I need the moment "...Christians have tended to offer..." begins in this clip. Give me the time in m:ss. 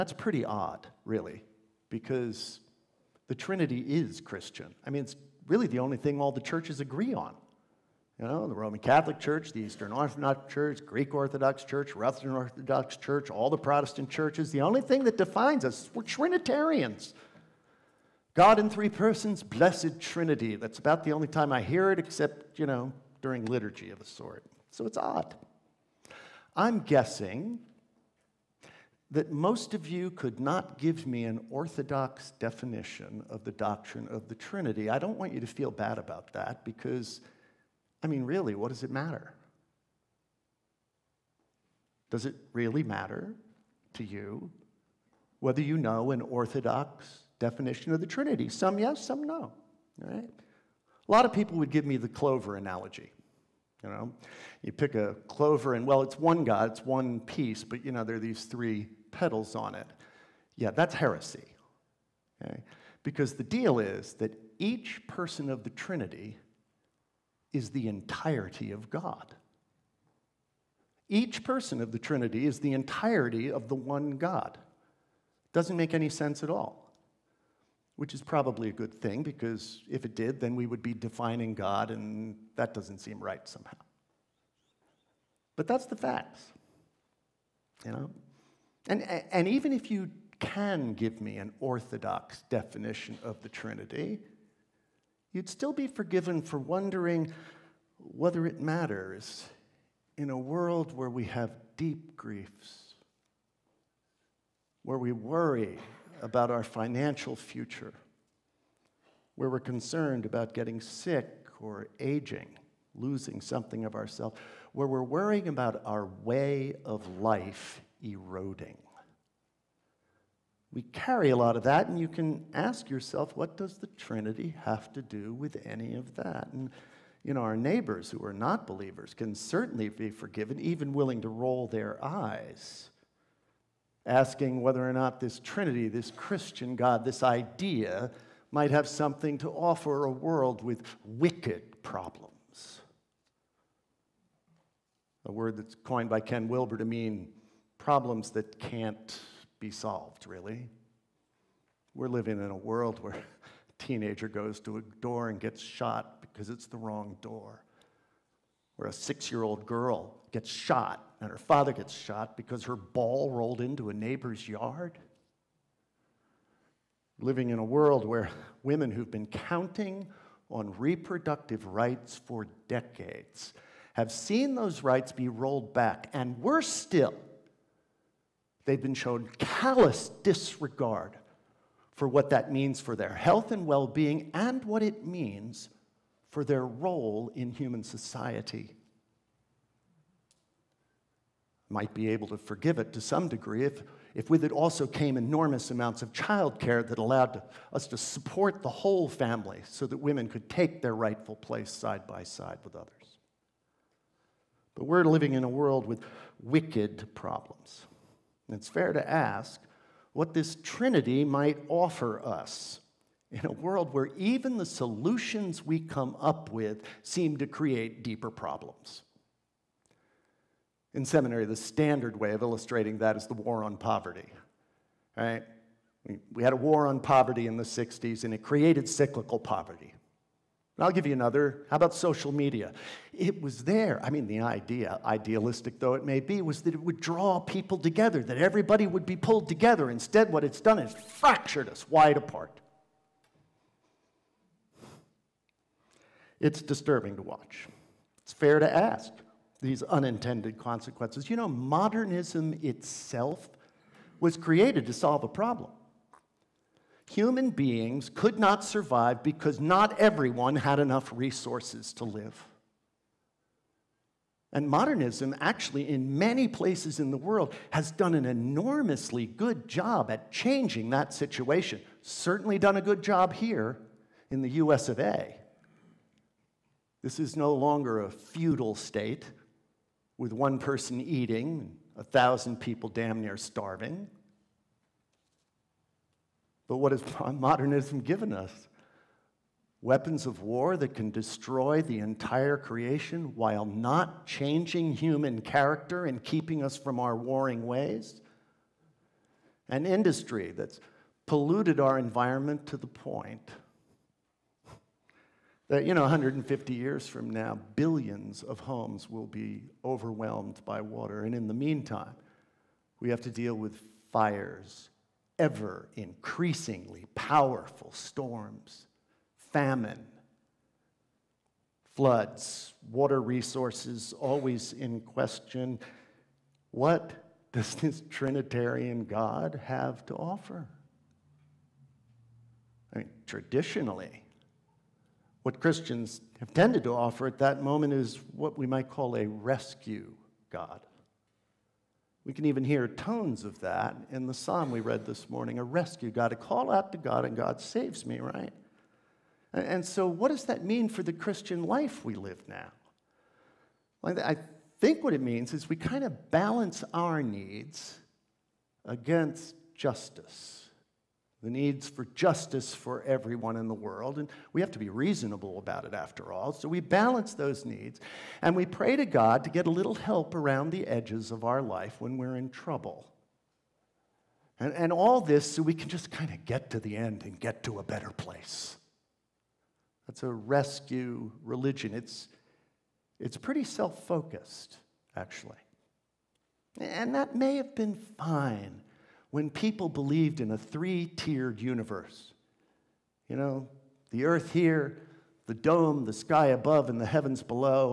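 5:35.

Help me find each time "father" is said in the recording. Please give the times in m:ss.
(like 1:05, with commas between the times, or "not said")
2:41.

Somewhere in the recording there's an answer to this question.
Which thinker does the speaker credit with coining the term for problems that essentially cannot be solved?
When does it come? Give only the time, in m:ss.
2:26.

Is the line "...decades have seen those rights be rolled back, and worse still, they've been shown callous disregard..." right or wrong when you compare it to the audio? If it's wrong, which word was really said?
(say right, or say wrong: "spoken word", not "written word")
right.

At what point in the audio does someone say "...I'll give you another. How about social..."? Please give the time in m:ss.
3:50.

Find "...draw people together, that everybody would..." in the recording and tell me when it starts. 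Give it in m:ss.
3:56.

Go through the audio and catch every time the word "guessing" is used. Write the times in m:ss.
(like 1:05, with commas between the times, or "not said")
0:26.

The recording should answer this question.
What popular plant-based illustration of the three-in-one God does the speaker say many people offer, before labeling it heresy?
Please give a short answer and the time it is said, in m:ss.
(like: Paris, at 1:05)
clover analogy, at 0:52.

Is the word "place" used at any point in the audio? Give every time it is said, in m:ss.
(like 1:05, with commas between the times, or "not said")
3:21, 4:26, 6:18.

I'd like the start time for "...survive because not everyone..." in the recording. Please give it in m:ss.
4:18.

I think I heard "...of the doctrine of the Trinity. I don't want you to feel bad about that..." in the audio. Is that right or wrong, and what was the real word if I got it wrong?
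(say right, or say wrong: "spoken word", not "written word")
right.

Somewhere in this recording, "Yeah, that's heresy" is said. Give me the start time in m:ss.
1:00.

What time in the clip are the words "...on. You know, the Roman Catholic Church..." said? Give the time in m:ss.
0:07.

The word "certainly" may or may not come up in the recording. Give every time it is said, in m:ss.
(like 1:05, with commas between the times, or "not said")
2:09, 4:32.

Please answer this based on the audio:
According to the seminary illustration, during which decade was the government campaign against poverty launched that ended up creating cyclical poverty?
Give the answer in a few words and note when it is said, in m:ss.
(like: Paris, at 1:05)
the 60s, at 3:47.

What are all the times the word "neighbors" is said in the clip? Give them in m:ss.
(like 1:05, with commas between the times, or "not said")
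2:07, 2:43.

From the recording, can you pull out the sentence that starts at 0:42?
Does it really matter to you whether you know an orthodox definition of the Trinity?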